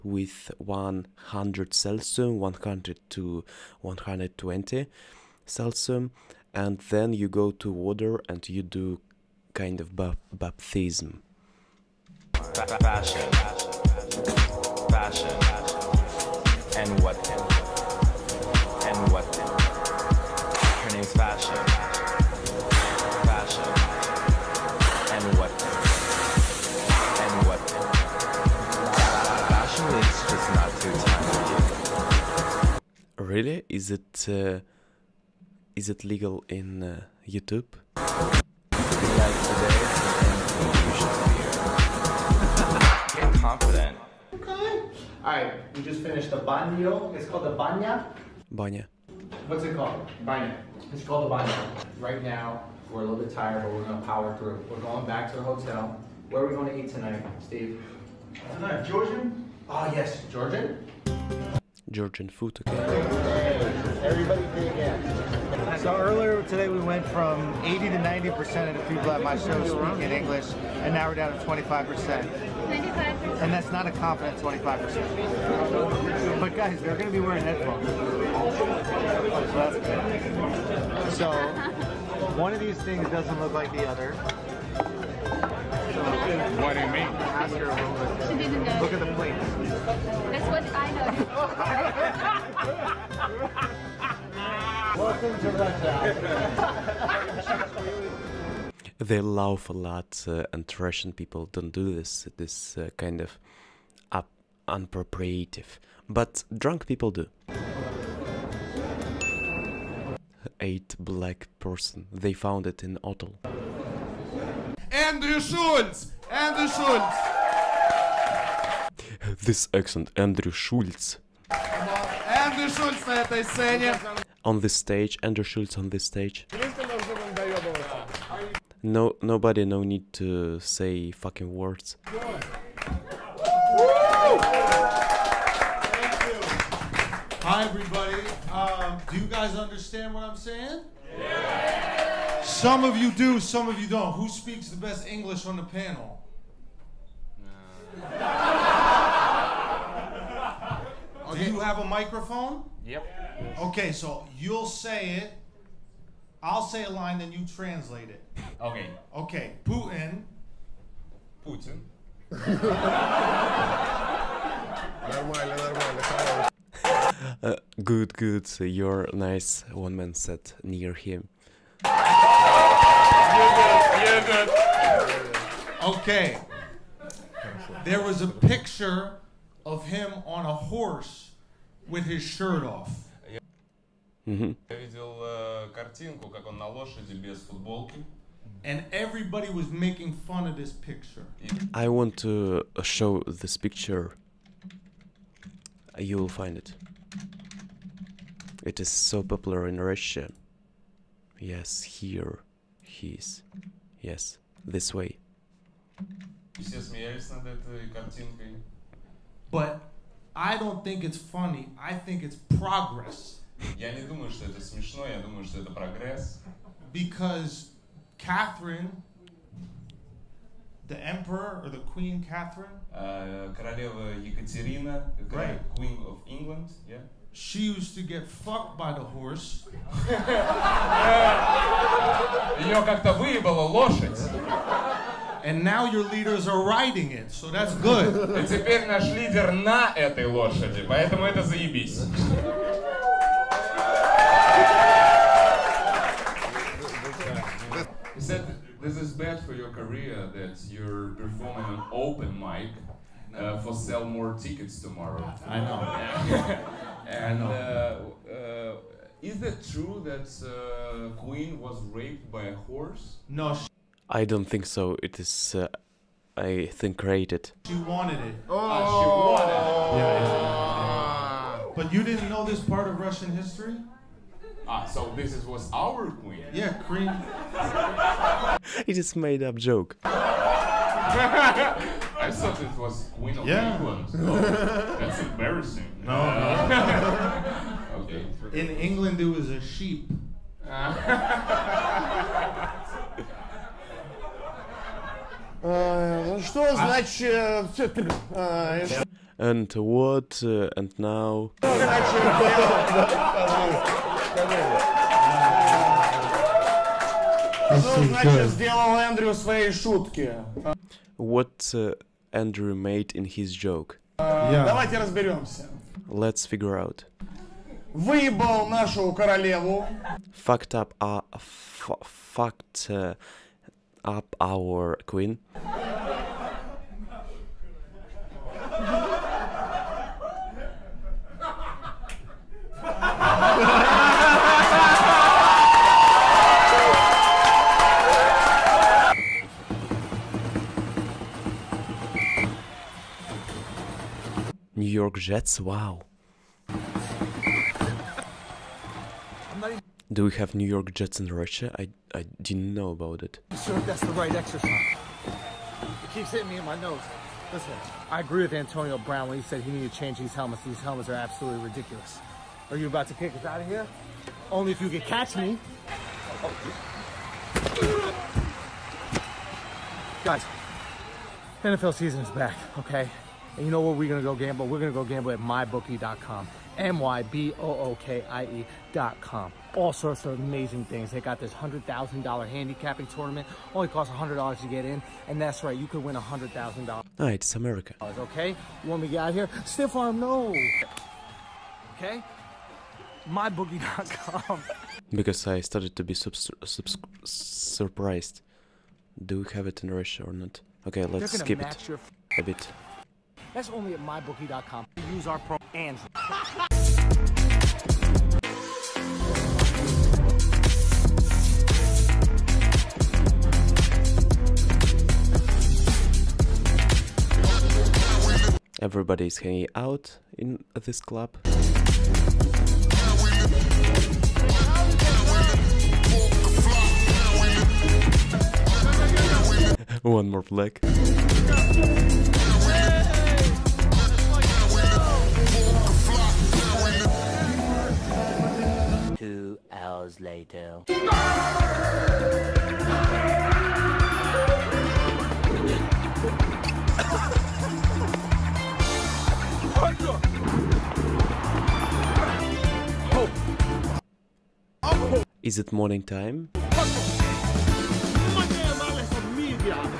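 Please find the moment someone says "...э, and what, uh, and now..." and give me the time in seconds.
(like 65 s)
297 s.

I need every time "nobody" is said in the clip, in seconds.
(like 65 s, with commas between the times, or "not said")
129 s.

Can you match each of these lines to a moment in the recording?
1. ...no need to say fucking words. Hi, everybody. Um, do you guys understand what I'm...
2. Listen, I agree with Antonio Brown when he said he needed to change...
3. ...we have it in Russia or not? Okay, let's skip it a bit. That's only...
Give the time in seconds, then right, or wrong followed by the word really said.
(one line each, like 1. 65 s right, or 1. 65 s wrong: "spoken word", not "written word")
1. 129 s right
2. 357 s right
3. 399 s right.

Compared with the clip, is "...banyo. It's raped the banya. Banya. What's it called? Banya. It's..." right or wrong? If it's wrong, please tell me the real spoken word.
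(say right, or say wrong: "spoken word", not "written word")
wrong: "called", not "raped".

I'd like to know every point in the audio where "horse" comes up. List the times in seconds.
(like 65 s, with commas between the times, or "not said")
180 s, 229 s, 262 s.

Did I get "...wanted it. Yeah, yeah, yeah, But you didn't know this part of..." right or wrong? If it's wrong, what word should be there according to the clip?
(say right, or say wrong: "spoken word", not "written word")
right.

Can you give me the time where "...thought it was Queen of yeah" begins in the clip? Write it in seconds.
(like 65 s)
282 s.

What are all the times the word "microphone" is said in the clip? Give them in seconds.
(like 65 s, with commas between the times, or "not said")
151 s.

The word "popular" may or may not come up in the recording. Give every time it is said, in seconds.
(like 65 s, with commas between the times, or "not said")
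199 s.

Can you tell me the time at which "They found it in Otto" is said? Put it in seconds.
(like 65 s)
112 s.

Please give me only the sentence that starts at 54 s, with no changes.
We're going back to the hotel.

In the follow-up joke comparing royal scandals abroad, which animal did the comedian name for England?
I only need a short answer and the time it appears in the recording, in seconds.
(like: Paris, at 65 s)
sheep, at 288 s.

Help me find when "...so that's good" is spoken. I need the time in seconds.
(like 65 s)
237 s.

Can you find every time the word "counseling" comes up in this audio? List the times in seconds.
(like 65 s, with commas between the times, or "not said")
not said.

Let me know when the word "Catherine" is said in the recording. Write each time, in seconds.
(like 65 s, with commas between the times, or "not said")
218 s, 222 s.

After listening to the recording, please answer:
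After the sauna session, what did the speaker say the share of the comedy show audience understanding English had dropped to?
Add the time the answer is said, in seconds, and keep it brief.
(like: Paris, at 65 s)
25 percent, at 70 s.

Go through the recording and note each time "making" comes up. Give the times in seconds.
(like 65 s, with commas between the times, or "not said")
189 s.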